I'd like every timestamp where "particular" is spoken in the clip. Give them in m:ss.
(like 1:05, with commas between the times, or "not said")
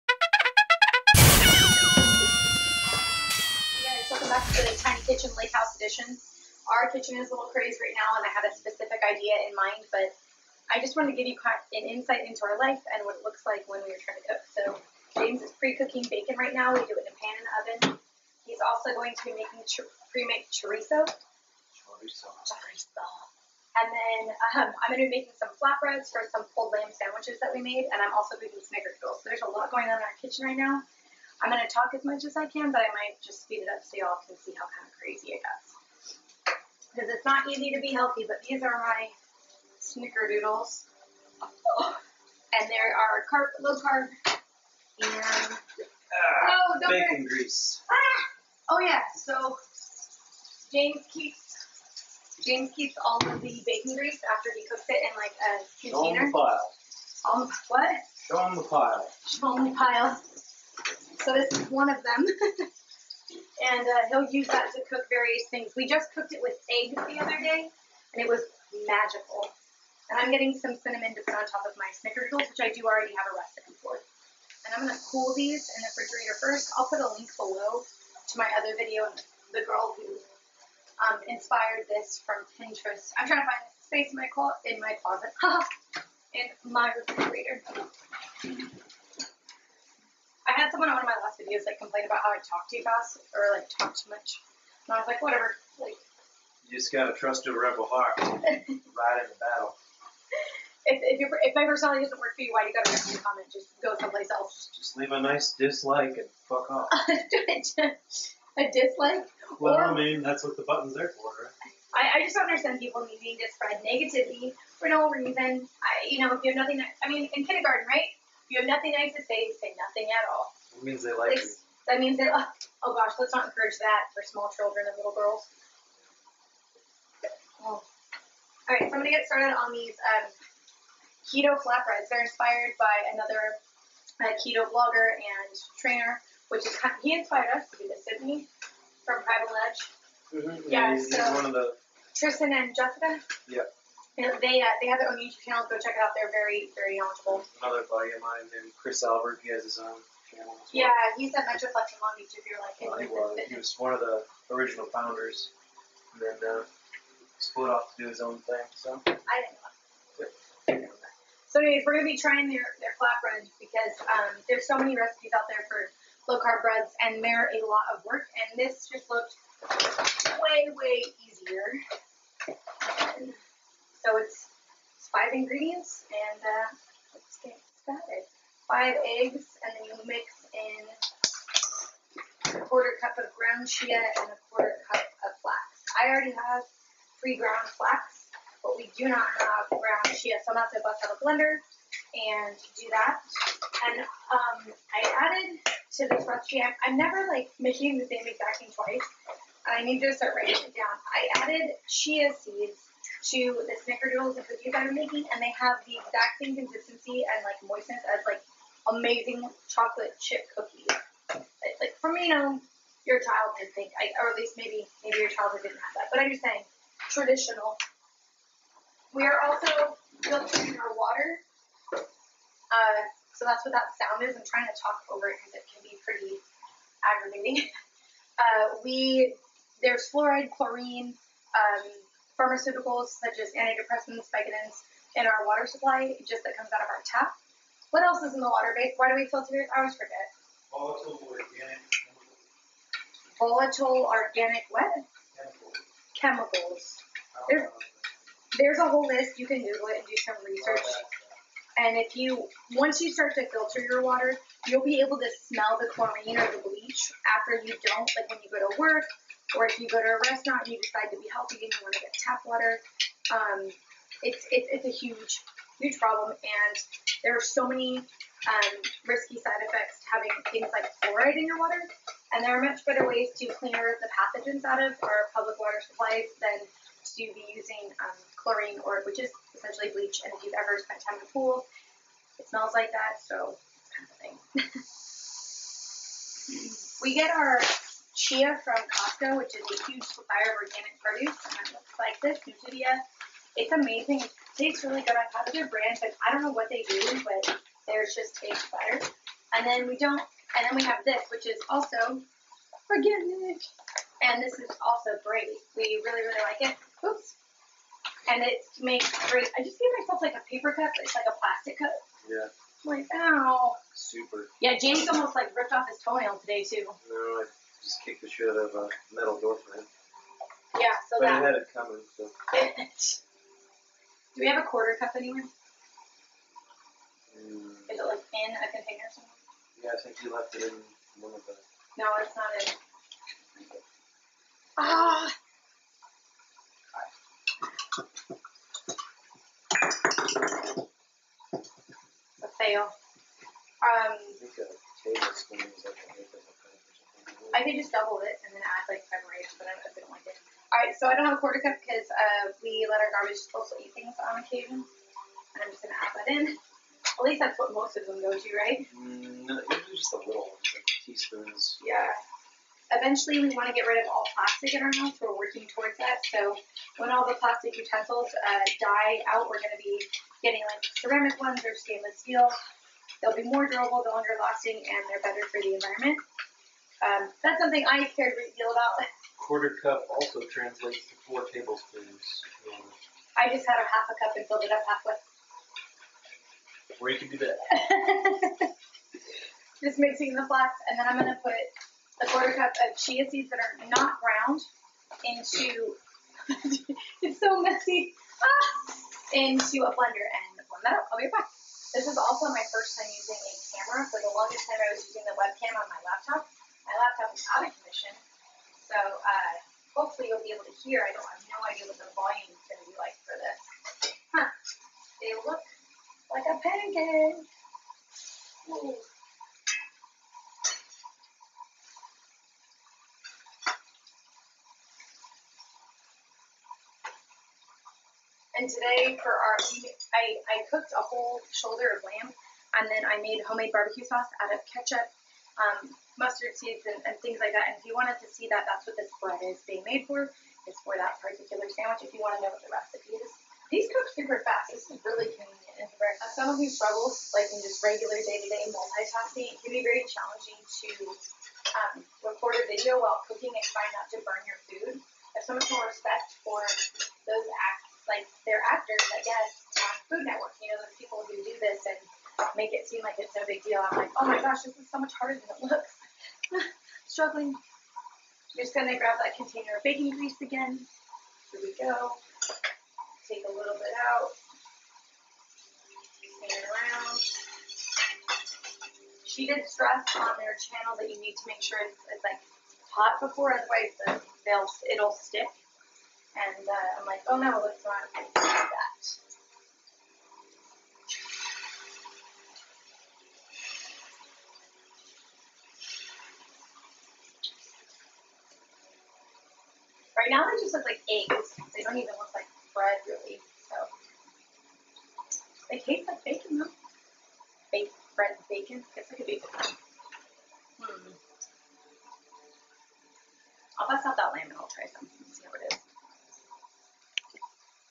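7:21.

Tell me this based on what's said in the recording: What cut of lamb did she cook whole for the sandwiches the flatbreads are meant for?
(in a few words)
Shoulder.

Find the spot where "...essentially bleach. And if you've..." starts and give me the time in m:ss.
4:39.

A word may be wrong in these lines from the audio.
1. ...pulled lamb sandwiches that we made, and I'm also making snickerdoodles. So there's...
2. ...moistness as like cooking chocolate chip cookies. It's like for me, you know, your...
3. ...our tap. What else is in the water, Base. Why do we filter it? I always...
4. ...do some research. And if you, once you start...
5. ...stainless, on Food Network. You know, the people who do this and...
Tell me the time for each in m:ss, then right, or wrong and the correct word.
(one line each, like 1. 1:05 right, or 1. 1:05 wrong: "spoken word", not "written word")
1. 0:26 right
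2. 3:27 wrong: "amazing", not "cooking"
3. 3:56 right
4. 4:10 right
5. 7:39 wrong: "guess", not "stainless".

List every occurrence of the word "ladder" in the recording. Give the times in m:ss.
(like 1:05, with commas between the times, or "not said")
not said.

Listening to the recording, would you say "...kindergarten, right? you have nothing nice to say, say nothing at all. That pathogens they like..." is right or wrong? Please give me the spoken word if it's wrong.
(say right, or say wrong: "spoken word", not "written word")
wrong: "means", not "pathogens".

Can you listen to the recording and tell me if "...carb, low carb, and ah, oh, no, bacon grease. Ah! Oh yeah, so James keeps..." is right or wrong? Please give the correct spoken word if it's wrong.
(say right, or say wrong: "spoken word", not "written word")
right.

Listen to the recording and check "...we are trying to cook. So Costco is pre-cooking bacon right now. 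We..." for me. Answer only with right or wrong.
wrong.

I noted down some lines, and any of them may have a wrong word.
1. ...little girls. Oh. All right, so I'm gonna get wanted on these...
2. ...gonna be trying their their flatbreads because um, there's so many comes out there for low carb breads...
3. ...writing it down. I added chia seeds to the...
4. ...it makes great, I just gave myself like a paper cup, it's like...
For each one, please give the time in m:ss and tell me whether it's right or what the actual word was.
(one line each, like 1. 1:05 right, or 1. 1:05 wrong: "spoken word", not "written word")
1. 2:04 wrong: "started", not "wanted"
2. 2:41 wrong: "recipes", not "comes"
3. 3:20 right
4. 5:08 right.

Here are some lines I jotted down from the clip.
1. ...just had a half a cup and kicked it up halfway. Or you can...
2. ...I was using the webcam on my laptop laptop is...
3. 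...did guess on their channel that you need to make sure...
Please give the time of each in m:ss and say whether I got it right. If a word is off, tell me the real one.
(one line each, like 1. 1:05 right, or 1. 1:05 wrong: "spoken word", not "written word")
1. 6:23 wrong: "filled", not "kicked"
2. 6:44 right
3. 7:59 wrong: "stress", not "guess".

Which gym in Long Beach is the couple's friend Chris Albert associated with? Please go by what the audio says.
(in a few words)
Metroflex.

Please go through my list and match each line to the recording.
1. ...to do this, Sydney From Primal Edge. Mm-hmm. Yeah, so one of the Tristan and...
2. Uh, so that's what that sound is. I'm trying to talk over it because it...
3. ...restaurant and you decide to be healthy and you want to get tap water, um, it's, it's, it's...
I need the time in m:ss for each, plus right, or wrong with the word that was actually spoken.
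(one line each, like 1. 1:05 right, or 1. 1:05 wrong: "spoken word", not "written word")
1. 2:17 right
2. 3:41 right
3. 4:20 right.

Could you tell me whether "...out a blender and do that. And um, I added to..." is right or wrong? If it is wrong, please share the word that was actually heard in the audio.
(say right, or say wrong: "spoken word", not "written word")
right.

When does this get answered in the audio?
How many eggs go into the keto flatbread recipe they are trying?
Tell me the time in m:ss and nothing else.
2:58.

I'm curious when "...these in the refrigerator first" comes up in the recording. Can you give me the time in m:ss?
1:15.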